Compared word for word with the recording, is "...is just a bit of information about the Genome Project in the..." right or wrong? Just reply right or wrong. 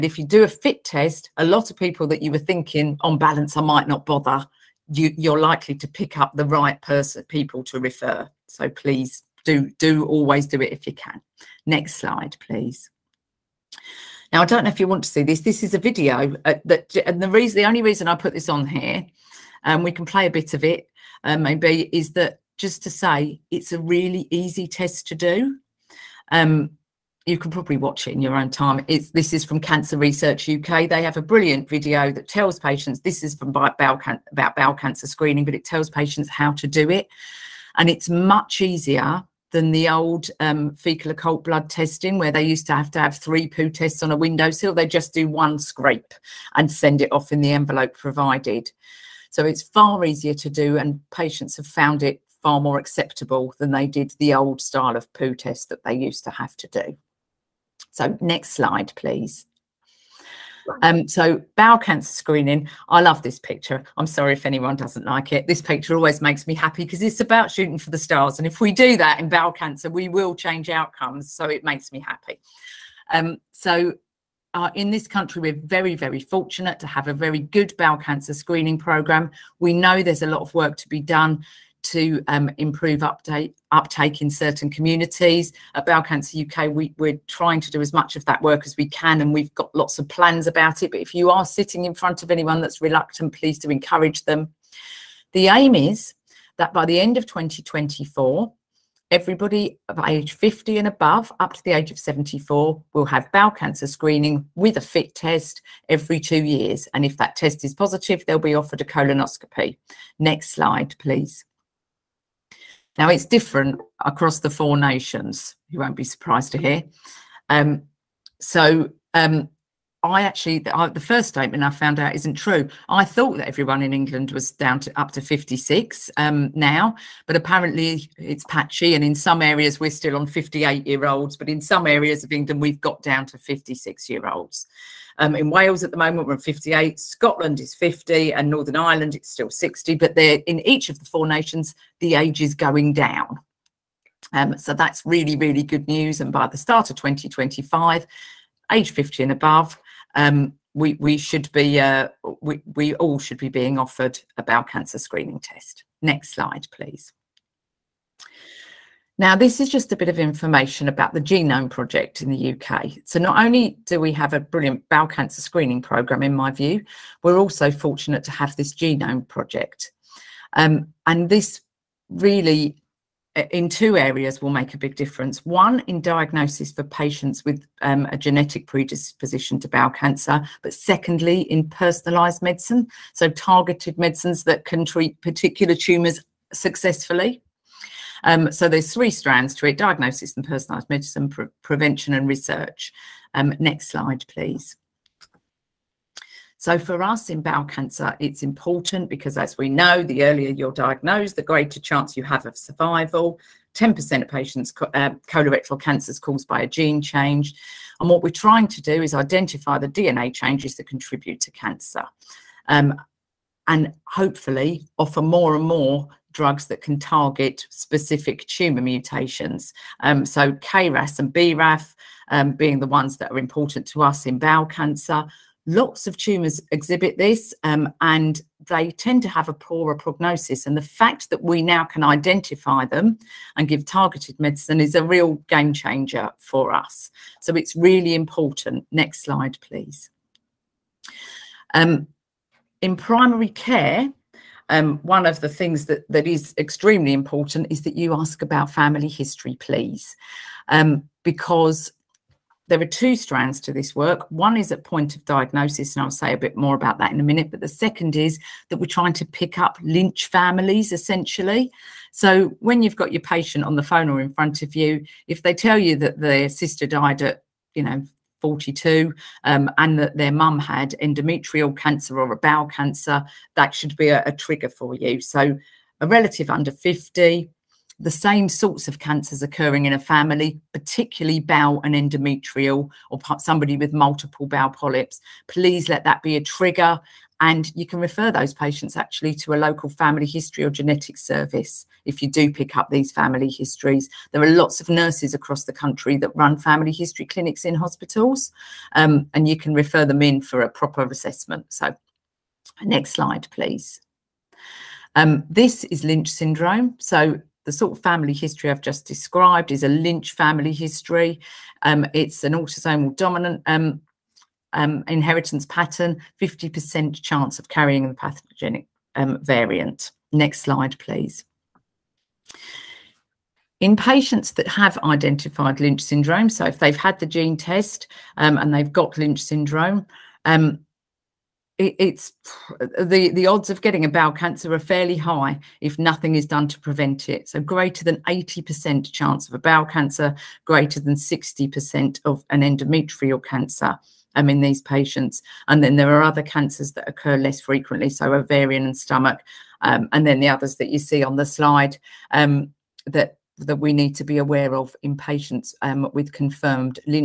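right.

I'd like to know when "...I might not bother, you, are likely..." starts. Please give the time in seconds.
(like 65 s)
3 s.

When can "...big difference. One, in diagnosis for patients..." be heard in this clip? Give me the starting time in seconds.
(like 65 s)
174 s.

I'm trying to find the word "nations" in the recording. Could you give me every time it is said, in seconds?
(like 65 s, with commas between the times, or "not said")
114 s, 141 s.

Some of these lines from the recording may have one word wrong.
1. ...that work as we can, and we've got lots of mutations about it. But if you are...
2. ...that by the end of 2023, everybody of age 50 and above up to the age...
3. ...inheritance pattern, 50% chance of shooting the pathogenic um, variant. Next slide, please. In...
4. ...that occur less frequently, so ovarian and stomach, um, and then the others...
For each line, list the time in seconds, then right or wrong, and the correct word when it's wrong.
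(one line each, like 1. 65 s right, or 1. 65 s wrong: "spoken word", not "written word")
1. 88 s wrong: "plans", not "mutations"
2. 96 s wrong: "2024", not "2023"
3. 315 s wrong: "carrying", not "shooting"
4. 346 s right.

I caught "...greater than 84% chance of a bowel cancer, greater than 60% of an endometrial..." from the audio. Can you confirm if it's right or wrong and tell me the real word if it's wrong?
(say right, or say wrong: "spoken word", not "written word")
wrong: "80", not "84".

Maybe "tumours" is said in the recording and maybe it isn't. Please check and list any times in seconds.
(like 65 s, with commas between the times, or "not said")
185 s, 218 s, 226 s.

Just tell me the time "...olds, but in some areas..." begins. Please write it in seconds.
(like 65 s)
131 s.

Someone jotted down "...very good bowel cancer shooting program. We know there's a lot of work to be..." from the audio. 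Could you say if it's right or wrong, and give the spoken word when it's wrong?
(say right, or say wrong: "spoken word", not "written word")
wrong: "screening", not "shooting".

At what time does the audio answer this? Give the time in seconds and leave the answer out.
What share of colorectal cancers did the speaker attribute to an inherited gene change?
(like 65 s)
203 s.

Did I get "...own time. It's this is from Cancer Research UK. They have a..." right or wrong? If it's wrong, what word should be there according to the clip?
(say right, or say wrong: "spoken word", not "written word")
right.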